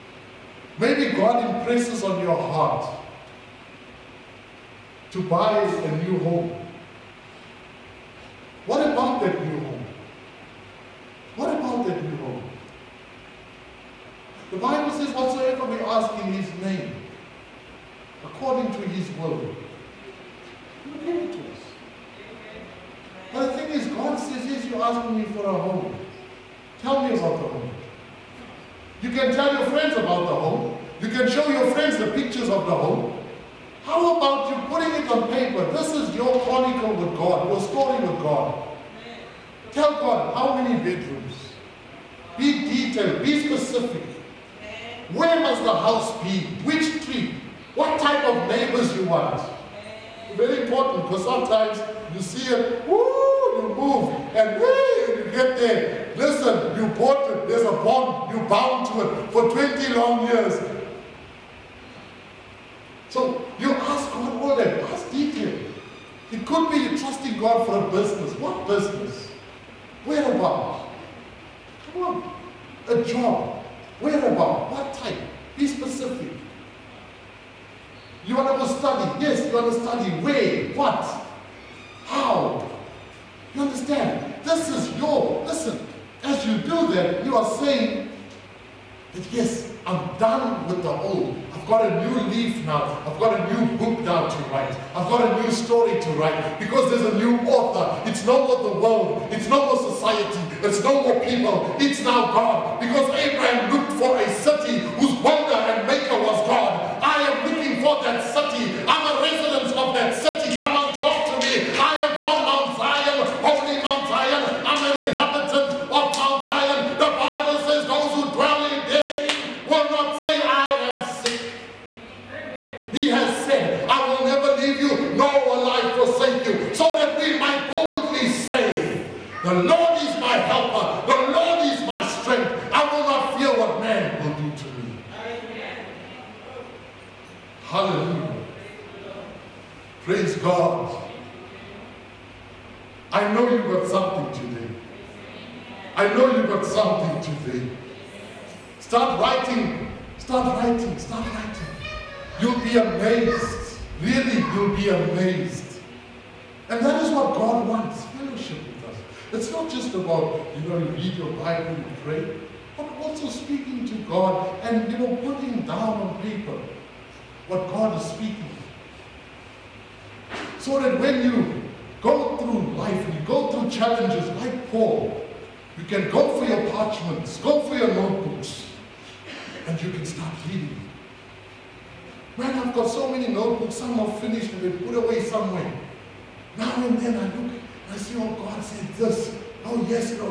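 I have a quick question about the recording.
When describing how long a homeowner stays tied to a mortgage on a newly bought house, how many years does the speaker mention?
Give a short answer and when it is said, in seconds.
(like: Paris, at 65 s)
20, at 59 s.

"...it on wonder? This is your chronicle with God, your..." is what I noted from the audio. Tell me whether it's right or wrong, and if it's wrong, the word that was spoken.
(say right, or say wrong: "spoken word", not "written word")
wrong: "paper", not "wonder".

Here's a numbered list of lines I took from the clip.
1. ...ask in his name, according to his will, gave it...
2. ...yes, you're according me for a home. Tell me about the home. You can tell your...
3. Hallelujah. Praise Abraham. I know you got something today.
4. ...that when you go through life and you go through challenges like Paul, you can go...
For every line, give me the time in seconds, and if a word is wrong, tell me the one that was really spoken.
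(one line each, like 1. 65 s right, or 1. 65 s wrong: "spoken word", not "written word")
1. 15 s right
2. 24 s wrong: "asking", not "according"
3. 137 s wrong: "God", not "Abraham"
4. 170 s right.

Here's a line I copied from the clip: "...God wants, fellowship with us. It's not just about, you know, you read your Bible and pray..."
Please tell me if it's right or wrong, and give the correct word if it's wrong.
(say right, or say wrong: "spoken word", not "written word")
right.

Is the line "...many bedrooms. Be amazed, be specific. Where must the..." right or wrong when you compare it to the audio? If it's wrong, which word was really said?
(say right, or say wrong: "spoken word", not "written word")
wrong: "detailed", not "amazed".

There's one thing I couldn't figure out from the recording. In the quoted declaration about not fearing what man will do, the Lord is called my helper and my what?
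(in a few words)
strength.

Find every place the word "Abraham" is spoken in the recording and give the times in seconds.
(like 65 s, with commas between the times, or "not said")
103 s.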